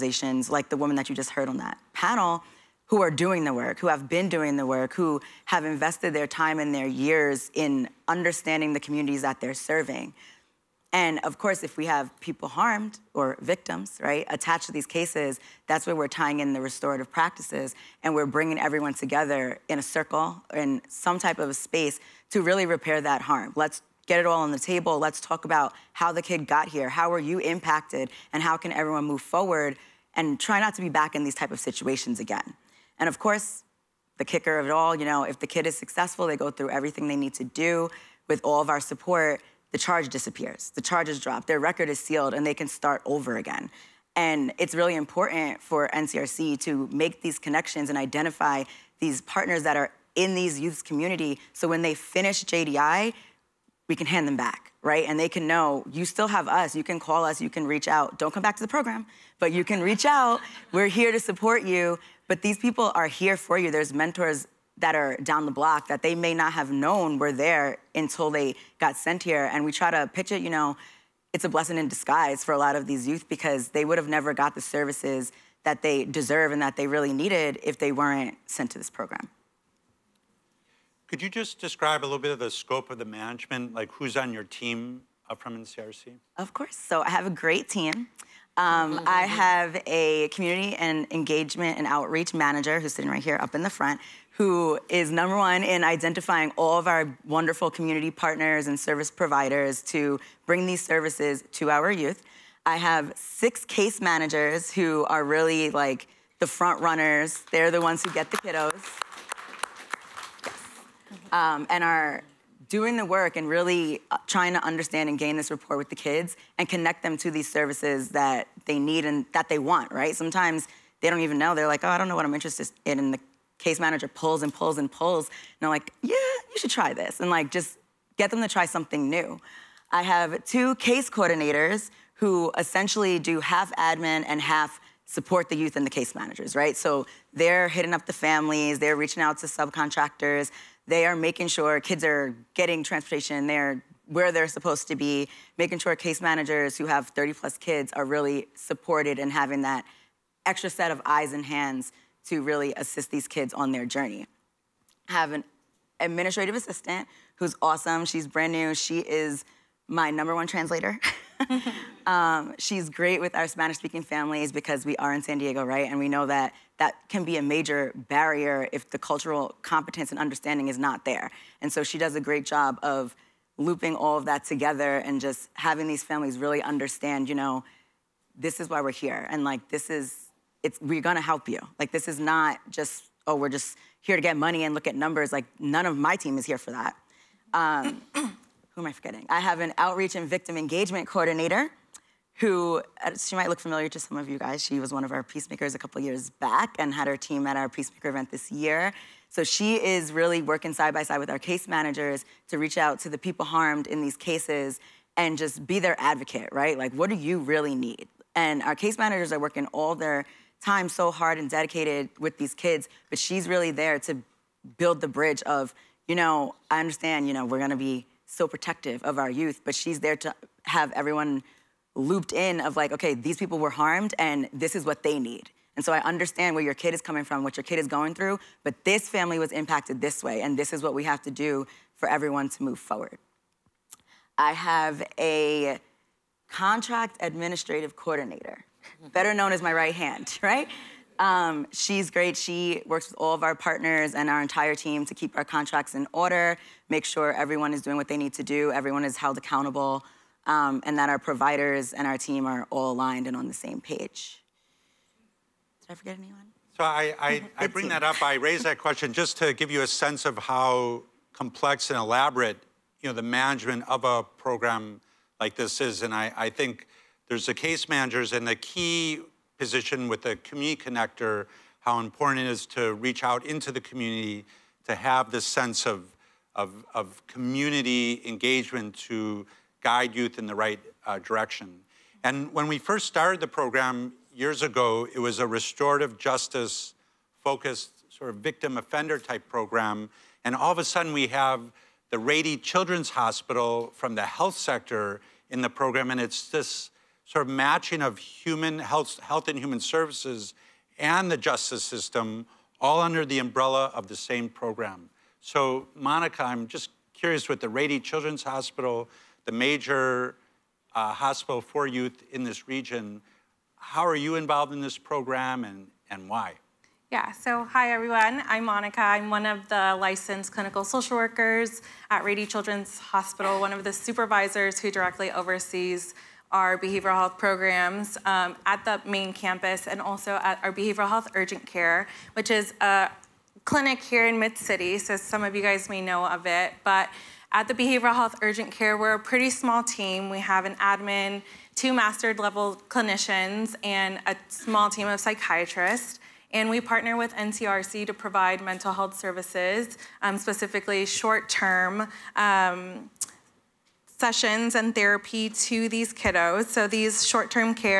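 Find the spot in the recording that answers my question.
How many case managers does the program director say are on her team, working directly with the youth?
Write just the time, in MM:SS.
01:43.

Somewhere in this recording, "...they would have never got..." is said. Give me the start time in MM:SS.
01:13.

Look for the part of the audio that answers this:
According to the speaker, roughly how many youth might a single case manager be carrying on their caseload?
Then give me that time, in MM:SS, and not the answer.
02:27.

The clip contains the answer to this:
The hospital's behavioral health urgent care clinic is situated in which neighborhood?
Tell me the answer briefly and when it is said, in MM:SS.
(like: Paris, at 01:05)
Mid City, at 05:34.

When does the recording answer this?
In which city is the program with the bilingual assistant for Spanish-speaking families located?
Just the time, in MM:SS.
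02:45.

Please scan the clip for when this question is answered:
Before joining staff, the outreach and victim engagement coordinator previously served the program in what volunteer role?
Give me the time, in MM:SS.
03:15.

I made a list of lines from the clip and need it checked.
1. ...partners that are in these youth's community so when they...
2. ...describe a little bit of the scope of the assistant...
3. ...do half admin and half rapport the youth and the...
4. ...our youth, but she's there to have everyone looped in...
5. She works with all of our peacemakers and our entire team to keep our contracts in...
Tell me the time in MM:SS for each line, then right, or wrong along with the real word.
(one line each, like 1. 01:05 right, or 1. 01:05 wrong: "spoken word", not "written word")
1. 00:49 right
2. 01:21 wrong: "management", not "assistant"
3. 02:13 wrong: "support", not "rapport"
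4. 03:39 right
5. 04:02 wrong: "partners", not "peacemakers".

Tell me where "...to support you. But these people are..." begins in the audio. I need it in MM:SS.
01:01.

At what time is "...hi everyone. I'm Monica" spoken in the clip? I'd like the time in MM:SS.
05:17.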